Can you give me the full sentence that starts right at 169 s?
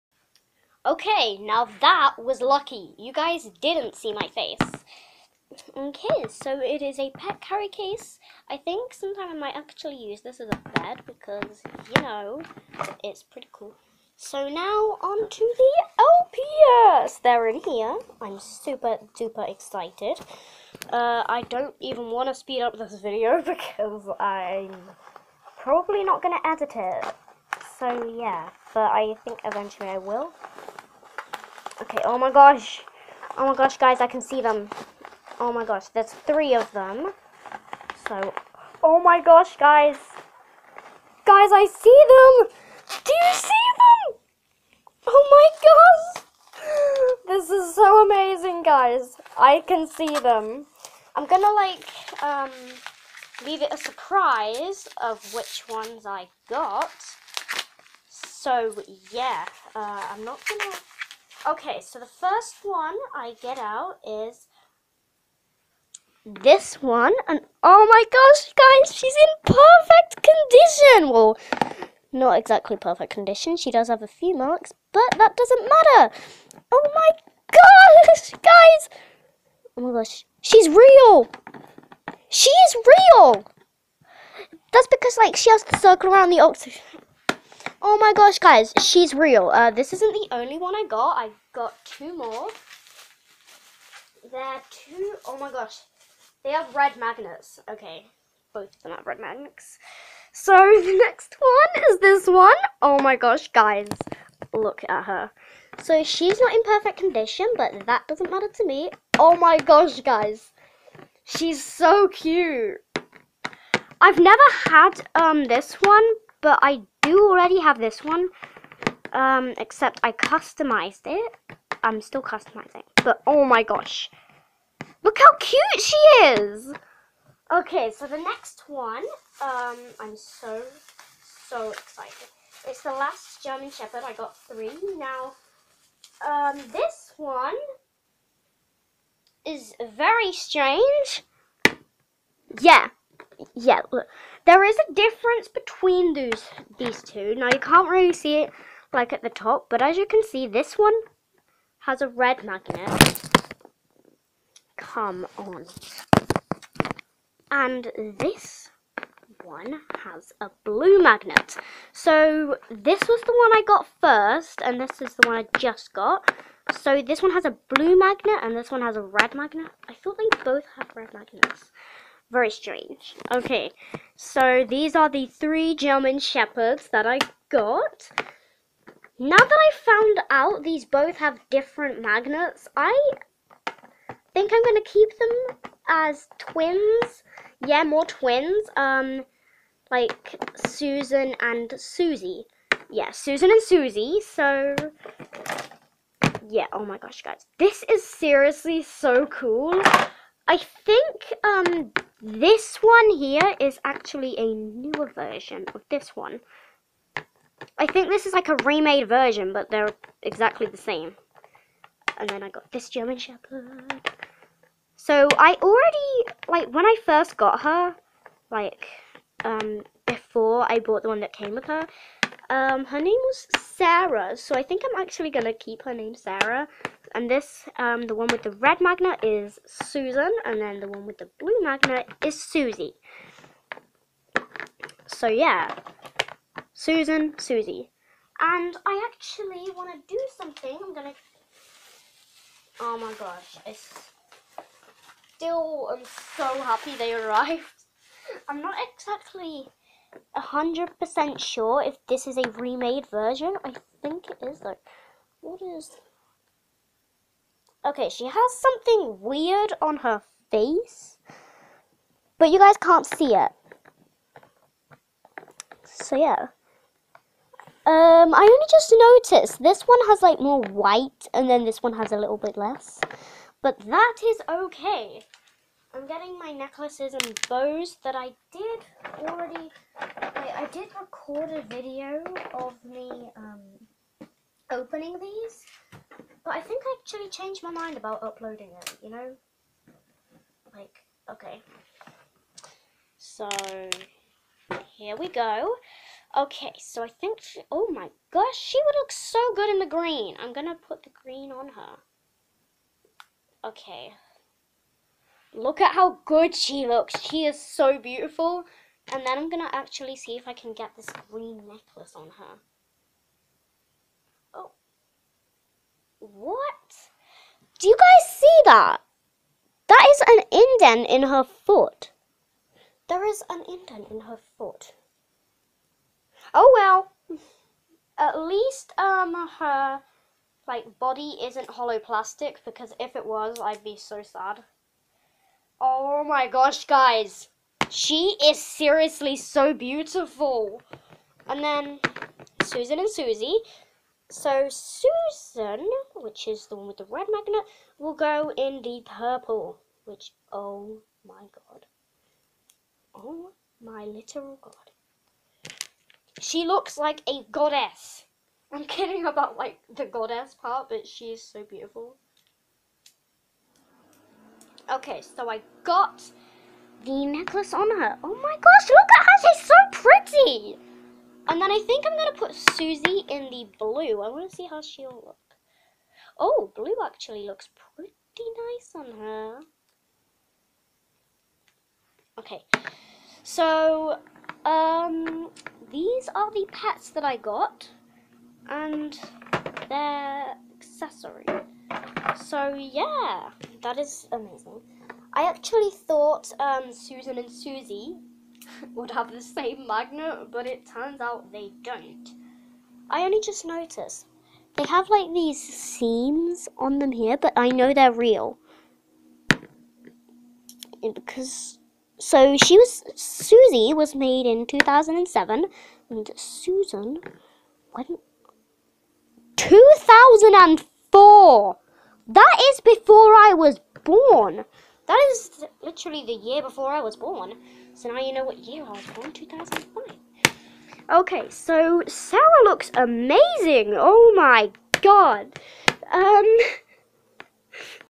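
I thought they both have red magnets very strange.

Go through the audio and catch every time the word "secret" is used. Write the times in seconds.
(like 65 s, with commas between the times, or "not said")
not said.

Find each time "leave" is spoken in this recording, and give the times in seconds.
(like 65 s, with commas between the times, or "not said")
53 s.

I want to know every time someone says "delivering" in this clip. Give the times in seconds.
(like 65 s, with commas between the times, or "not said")
not said.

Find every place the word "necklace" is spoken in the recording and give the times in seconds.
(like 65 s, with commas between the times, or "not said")
276 s, 311 s, 367 s.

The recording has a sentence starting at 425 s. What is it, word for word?
That is literally the year before I was born.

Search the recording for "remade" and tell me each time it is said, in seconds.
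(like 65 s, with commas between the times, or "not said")
208 s, 252 s.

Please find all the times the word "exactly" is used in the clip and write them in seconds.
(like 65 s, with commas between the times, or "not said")
72 s, 210 s, 248 s.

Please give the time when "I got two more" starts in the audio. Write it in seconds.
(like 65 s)
91 s.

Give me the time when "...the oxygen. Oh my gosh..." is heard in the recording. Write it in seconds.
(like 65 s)
86 s.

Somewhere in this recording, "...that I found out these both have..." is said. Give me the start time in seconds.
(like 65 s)
179 s.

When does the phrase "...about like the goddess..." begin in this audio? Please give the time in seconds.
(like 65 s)
359 s.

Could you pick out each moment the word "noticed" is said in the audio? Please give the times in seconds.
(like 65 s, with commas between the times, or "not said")
269 s, 403 s.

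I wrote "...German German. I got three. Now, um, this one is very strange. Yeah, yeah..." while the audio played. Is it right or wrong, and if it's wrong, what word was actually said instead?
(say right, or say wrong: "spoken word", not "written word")
wrong: "Shepherd", not "German".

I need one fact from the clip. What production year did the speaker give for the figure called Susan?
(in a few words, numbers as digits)
2004.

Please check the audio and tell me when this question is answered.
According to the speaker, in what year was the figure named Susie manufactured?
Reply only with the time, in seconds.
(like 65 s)
414 s.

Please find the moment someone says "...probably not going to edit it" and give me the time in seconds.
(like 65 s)
25 s.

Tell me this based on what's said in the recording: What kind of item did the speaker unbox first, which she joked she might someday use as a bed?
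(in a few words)
pet carry case.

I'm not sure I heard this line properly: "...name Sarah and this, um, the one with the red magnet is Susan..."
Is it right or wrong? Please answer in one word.
right.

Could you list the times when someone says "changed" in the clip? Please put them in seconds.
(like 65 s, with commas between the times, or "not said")
287 s.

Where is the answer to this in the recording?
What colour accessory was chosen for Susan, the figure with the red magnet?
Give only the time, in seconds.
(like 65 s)
349 s.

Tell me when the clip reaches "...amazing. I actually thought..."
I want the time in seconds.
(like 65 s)
394 s.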